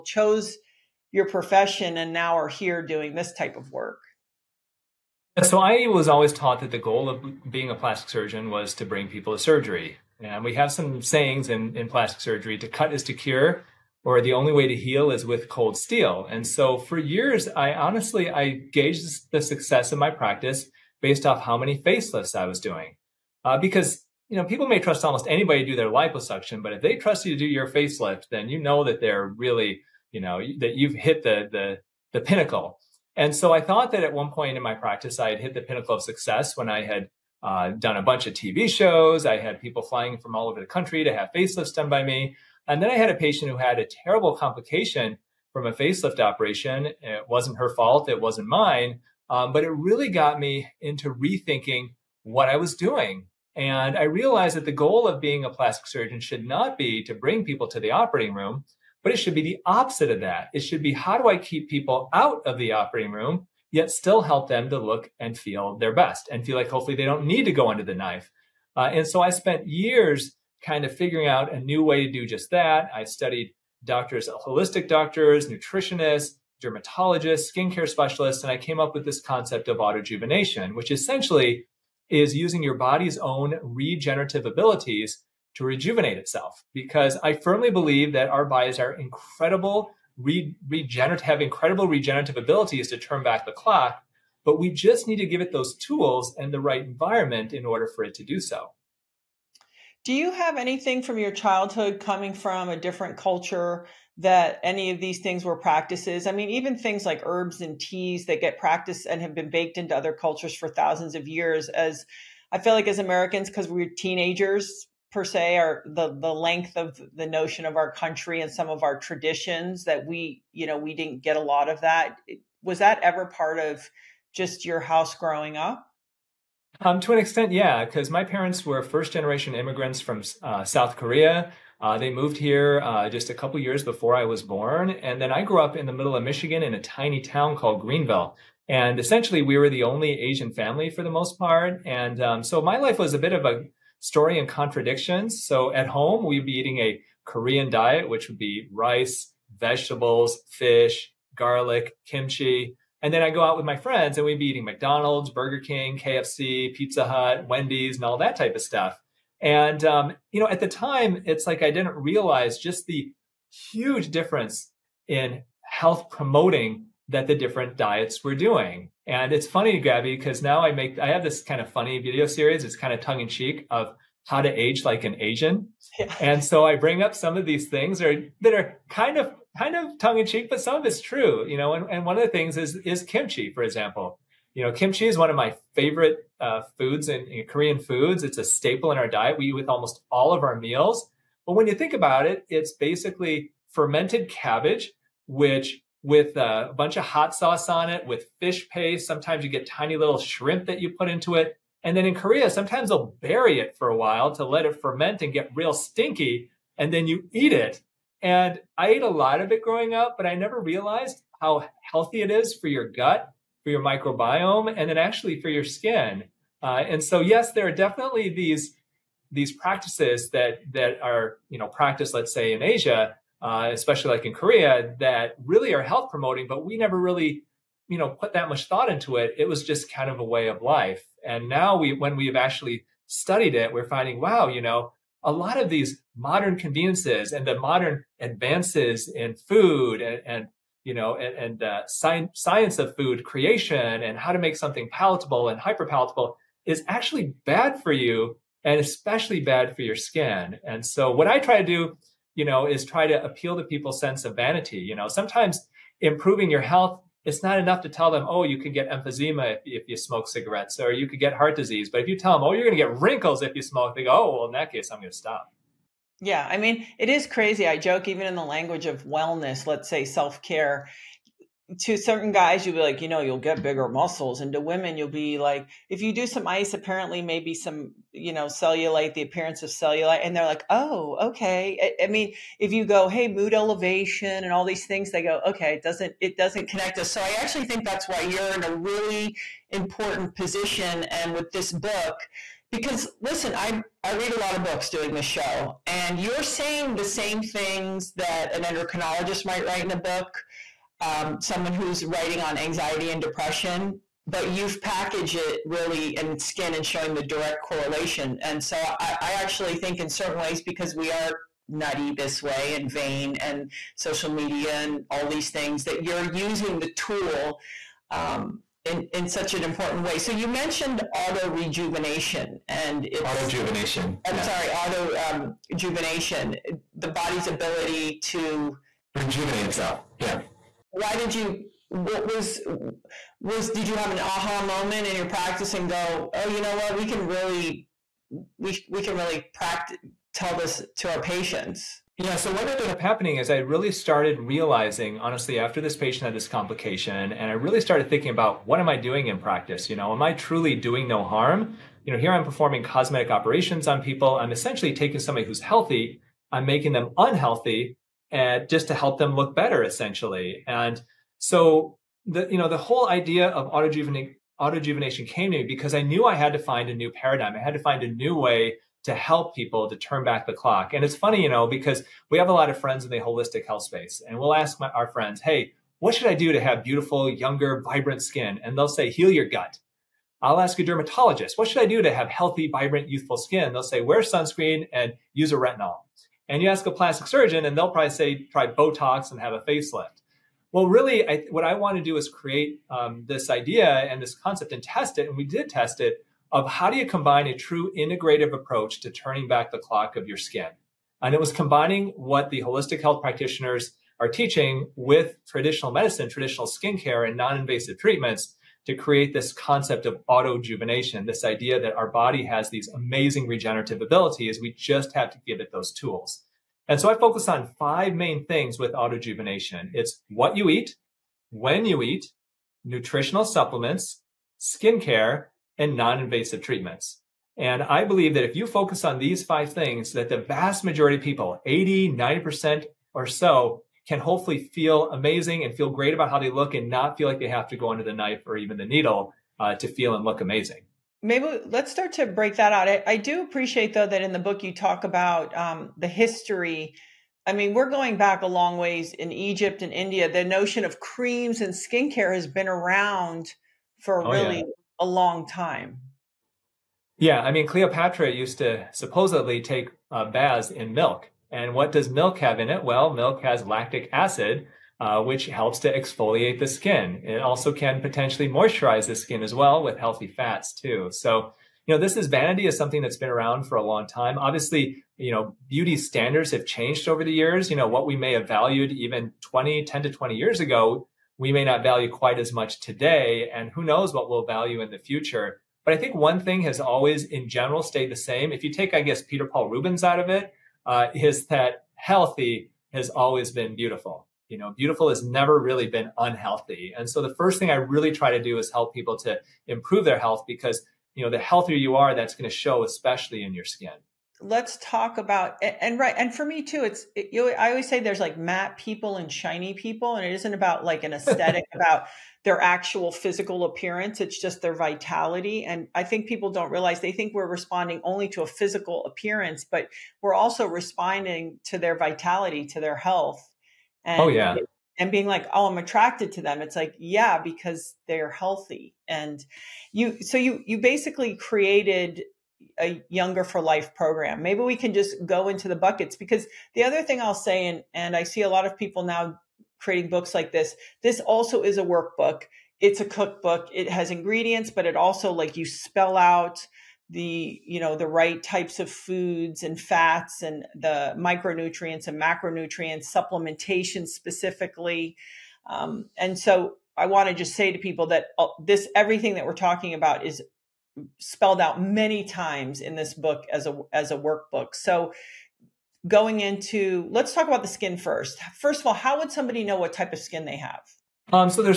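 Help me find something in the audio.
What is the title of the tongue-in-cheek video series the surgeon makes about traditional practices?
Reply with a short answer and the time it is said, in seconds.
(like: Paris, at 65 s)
How to age like an Asian, at 174 s.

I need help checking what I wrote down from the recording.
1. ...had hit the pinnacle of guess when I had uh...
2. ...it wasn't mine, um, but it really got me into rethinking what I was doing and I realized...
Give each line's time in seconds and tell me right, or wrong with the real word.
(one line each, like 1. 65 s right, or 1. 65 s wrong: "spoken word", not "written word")
1. 35 s wrong: "success", not "guess"
2. 48 s right.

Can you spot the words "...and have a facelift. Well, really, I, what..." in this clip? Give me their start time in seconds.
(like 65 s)
389 s.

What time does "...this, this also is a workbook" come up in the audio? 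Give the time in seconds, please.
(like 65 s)
540 s.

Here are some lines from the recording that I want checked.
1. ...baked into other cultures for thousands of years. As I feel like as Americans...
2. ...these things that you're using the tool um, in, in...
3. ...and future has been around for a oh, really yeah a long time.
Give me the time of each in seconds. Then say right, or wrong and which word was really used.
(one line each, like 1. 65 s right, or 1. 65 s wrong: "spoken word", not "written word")
1. 109 s right
2. 315 s right
3. 451 s wrong: "skincare", not "future".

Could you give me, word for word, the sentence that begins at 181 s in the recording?
And, and one of the things is is kimchi, for example.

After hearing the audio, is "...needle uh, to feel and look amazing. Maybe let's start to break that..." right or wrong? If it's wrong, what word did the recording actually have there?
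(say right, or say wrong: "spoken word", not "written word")
right.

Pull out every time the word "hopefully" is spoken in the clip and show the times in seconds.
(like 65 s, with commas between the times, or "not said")
66 s, 434 s.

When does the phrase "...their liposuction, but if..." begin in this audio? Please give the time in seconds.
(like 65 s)
25 s.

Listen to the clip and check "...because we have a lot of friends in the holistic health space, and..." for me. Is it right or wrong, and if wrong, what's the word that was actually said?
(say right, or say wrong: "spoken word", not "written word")
right.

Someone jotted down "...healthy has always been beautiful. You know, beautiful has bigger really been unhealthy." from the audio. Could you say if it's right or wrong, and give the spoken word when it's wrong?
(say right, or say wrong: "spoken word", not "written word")
wrong: "never", not "bigger".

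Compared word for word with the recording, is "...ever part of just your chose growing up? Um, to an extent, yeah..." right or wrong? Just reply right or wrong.
wrong.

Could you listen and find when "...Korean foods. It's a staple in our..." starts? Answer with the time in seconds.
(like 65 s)
187 s.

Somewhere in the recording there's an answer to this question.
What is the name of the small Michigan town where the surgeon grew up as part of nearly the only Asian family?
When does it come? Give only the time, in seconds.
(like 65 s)
137 s.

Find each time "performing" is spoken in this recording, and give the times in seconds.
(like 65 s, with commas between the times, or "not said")
352 s.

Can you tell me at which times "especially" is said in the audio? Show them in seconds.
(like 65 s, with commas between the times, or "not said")
223 s, 248 s, 502 s.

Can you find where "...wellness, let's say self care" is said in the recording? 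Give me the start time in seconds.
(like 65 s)
269 s.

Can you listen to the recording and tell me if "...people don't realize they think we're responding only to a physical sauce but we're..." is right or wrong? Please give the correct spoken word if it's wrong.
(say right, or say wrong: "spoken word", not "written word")
wrong: "appearance", not "sauce".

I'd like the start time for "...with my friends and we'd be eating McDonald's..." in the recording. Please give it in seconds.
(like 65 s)
153 s.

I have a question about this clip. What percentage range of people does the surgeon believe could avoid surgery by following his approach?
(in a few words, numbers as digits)
80 to 90%.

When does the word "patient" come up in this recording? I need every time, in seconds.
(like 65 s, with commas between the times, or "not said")
43 s, 341 s, 345 s.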